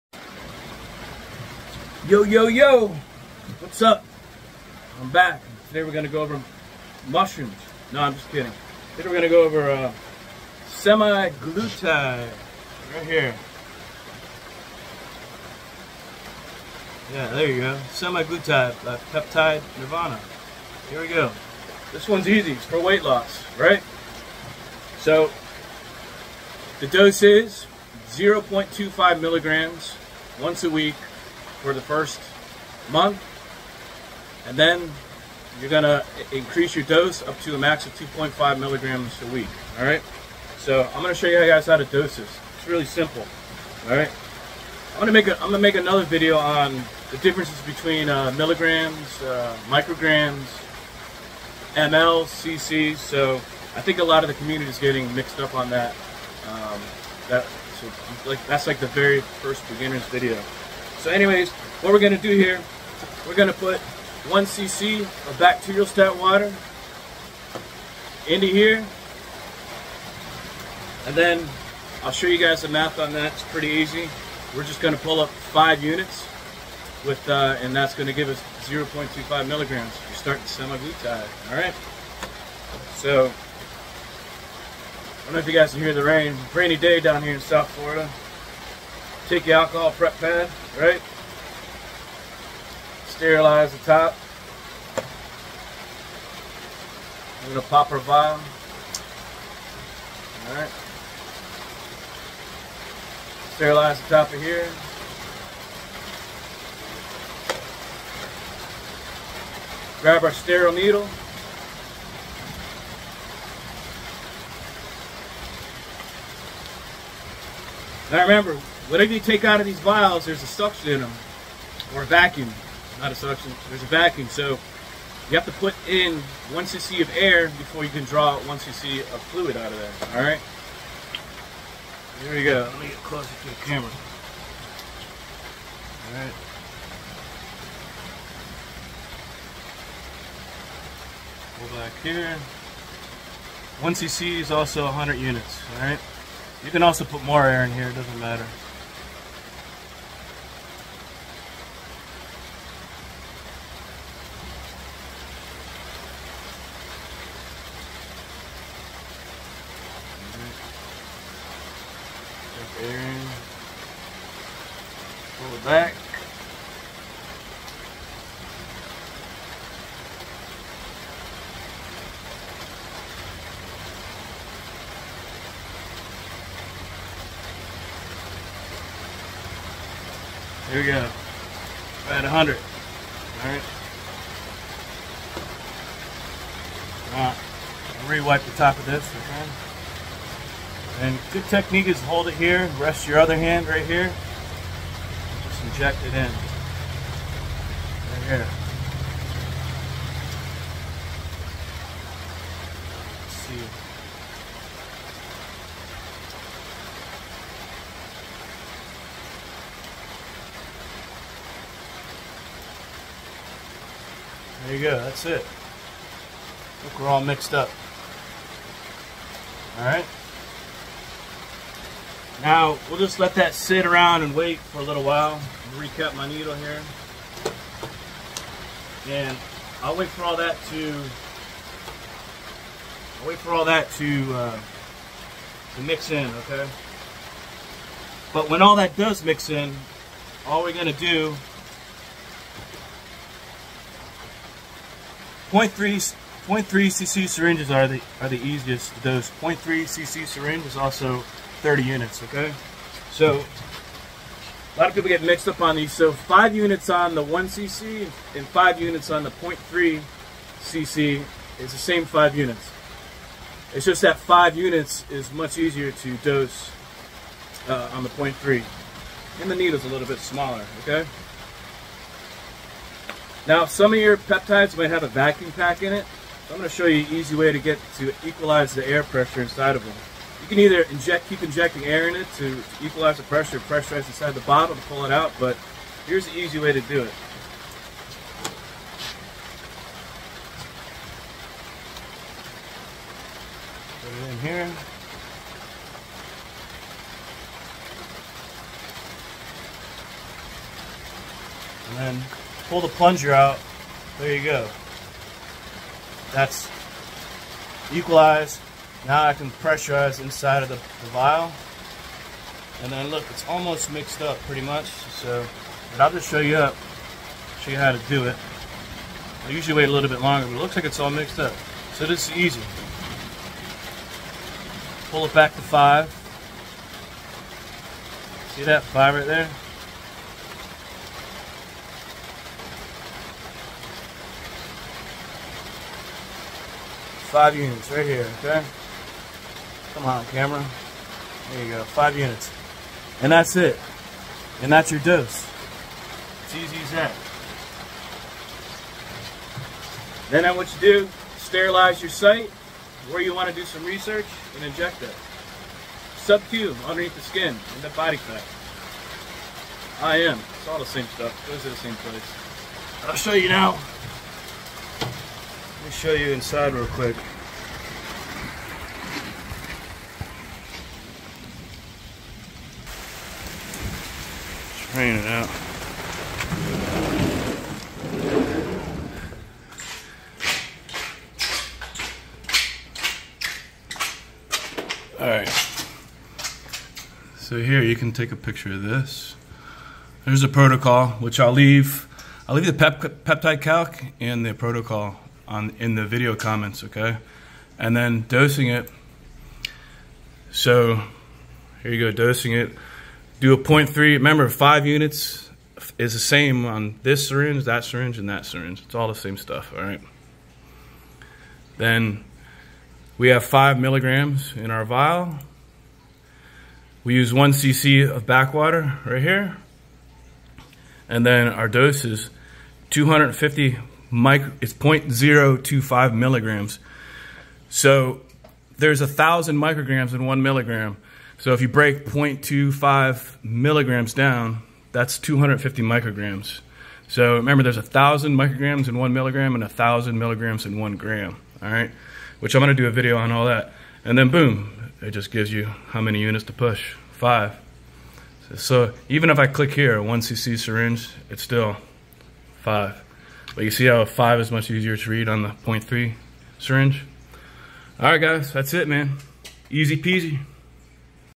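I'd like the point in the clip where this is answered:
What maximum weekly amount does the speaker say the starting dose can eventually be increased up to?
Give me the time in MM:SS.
00:37.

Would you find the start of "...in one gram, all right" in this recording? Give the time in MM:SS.
07:20.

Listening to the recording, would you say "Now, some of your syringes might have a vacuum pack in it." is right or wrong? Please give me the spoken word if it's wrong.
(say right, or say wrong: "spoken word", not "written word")
wrong: "peptides", not "syringes".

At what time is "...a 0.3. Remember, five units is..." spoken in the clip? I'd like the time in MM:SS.
06:43.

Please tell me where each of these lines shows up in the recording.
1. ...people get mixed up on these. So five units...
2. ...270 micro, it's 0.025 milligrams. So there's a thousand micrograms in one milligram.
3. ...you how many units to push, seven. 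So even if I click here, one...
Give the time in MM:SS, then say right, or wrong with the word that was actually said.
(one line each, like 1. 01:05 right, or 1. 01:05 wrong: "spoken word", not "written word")
1. 04:14 right
2. 07:02 wrong: "250", not "270"
3. 07:25 wrong: "five", not "seven".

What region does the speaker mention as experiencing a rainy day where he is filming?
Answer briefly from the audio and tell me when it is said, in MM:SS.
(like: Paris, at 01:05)
South Florida, at 01:27.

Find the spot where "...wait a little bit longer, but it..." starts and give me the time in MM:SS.
05:19.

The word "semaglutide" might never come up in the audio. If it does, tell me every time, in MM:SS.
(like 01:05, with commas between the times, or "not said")
01:20.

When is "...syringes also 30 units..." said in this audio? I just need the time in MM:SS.
04:10.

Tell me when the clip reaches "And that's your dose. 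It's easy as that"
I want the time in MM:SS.
05:44.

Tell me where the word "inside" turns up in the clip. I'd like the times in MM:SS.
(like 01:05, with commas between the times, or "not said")
04:39, 04:44, 05:10, 06:06.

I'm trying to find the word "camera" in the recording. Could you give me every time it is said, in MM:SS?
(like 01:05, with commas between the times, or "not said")
02:13, 05:40.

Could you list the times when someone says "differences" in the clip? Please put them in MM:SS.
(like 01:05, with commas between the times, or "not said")
00:47.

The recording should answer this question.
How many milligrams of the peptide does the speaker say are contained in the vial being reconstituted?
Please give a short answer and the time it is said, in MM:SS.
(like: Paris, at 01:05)
5 milligrams, at 06:53.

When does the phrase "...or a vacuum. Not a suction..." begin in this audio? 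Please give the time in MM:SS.
02:01.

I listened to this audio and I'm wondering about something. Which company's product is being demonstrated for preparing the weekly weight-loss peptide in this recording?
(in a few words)
Peptide Nirvana.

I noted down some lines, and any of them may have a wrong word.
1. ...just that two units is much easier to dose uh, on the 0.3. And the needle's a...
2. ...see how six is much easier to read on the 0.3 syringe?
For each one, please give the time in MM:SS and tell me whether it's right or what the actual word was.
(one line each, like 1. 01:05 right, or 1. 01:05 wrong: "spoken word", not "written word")
1. 04:23 wrong: "five", not "two"
2. 07:33 wrong: "five", not "six".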